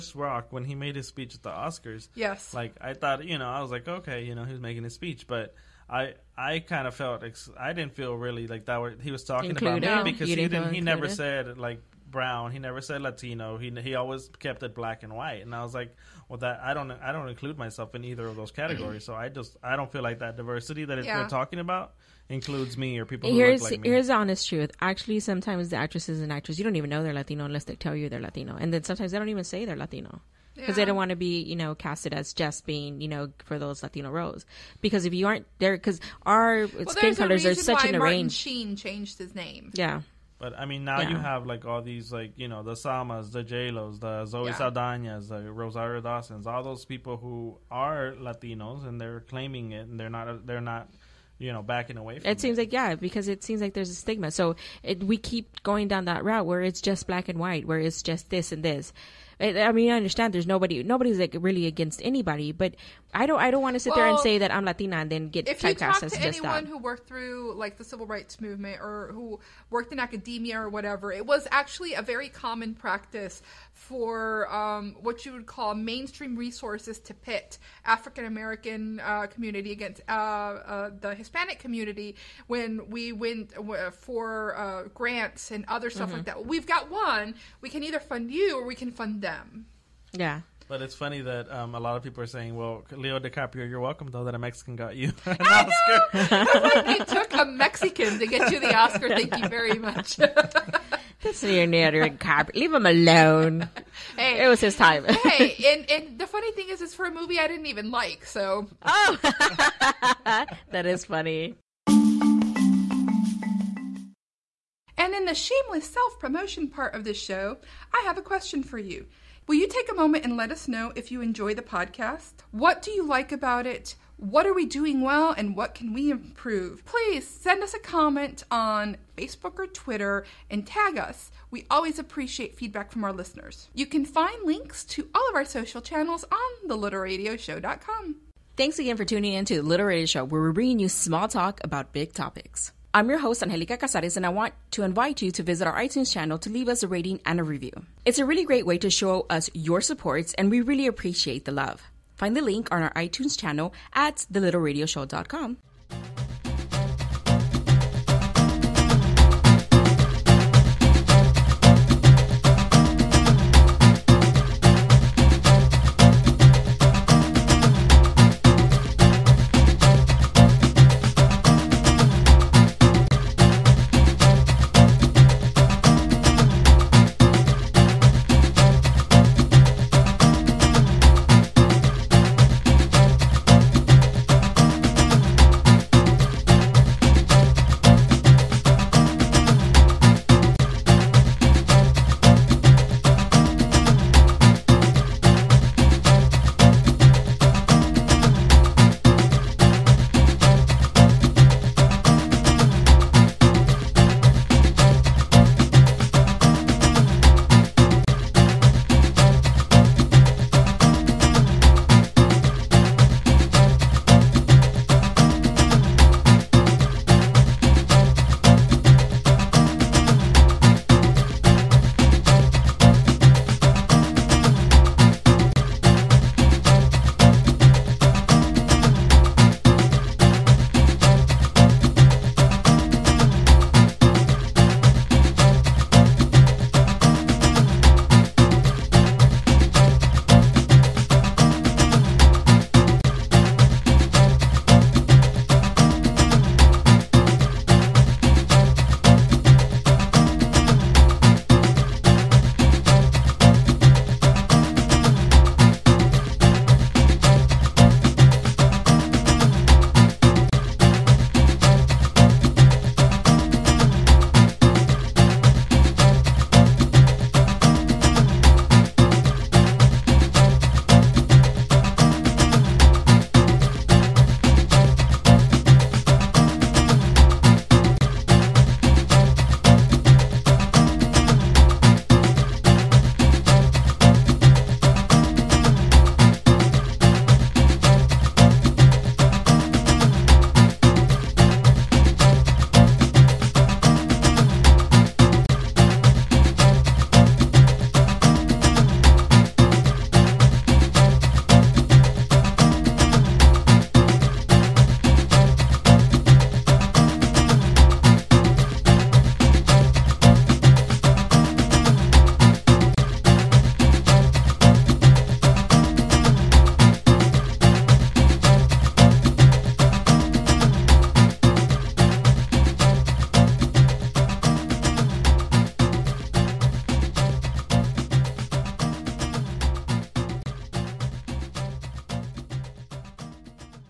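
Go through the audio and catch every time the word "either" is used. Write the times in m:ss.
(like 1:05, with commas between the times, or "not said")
0:18, 1:27.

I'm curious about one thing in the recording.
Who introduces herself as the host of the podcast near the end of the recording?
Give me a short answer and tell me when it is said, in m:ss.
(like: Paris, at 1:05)
Anjelica Cazares, at 2:23.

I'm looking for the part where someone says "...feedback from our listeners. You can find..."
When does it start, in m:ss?
2:12.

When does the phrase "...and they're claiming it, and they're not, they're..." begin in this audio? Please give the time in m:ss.
0:48.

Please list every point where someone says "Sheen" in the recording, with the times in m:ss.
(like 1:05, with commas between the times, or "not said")
0:38.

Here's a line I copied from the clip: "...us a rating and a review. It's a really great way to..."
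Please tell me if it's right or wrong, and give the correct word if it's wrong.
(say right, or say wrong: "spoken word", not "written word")
right.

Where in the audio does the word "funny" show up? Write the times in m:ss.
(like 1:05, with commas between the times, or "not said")
1:30, 1:46, 1:51.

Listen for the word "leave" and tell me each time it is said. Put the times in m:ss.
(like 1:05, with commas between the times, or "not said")
1:42, 2:26.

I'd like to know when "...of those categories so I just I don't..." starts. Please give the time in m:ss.
0:18.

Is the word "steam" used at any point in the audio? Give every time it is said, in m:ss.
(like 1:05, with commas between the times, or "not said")
not said.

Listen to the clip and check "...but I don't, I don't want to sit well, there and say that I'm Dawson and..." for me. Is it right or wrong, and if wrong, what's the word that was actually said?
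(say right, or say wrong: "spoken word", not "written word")
wrong: "Latina", not "Dawson".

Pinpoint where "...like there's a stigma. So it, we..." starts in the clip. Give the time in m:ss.
0:53.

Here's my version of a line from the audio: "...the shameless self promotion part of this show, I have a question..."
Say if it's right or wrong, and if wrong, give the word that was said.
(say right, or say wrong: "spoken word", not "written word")
right.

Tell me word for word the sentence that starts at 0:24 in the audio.
Actually, sometimes the actresses and actors, you don't even know they're Latino unless they tell you they're Latino.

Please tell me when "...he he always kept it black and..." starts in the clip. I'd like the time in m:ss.
0:13.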